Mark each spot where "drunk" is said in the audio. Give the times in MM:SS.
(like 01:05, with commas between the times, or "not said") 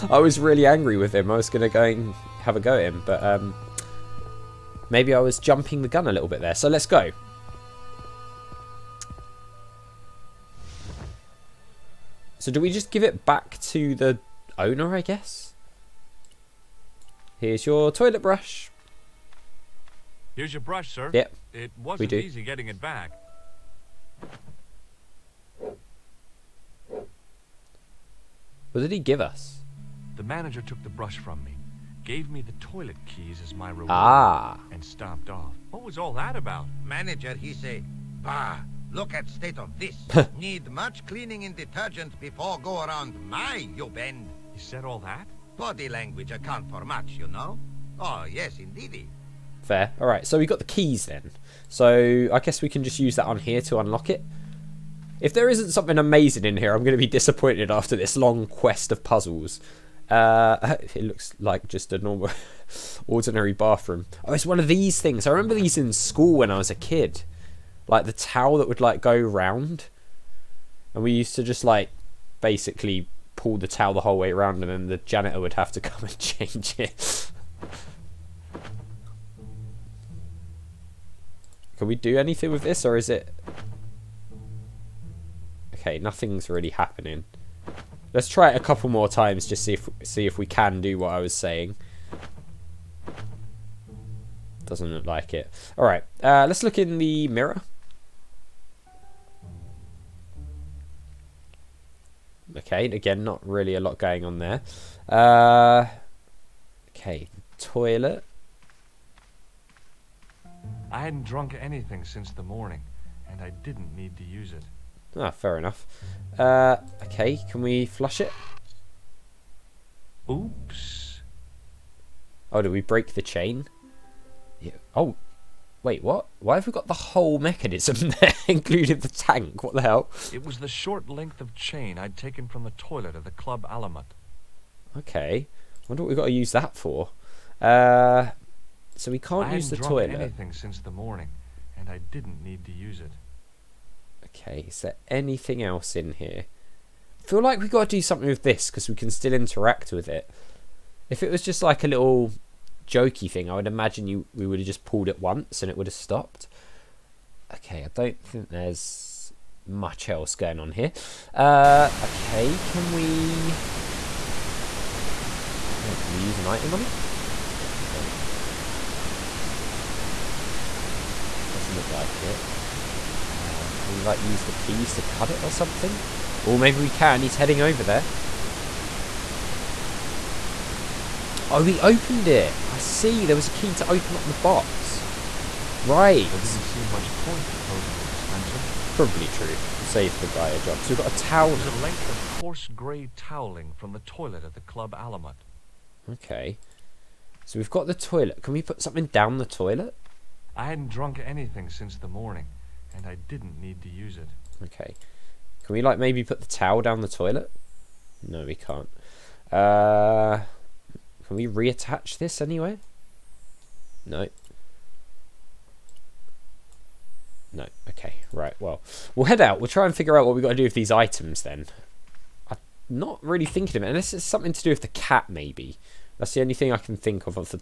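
01:51, 03:20.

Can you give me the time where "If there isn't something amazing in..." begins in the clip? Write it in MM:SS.
00:55.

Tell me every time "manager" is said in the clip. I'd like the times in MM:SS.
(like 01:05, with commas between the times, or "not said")
00:30, 00:36.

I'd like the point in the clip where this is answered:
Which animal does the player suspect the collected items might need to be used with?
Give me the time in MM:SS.
03:44.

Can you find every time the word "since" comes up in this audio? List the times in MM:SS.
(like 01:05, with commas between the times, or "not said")
01:52, 02:20, 03:21.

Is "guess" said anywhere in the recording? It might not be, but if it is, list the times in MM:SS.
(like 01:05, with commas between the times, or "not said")
00:15, 00:52.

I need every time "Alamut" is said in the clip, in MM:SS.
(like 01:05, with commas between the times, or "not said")
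02:13, 03:14.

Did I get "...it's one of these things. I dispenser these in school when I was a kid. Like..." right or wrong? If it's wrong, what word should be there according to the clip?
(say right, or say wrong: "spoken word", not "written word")
wrong: "remember", not "dispenser".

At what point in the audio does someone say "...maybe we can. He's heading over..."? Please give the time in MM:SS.
02:56.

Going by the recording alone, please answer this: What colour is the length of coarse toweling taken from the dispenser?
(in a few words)
Grey.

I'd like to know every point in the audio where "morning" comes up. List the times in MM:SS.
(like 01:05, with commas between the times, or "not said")
01:52, 02:20, 03:22.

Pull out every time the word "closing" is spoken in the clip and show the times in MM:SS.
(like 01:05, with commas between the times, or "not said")
03:07.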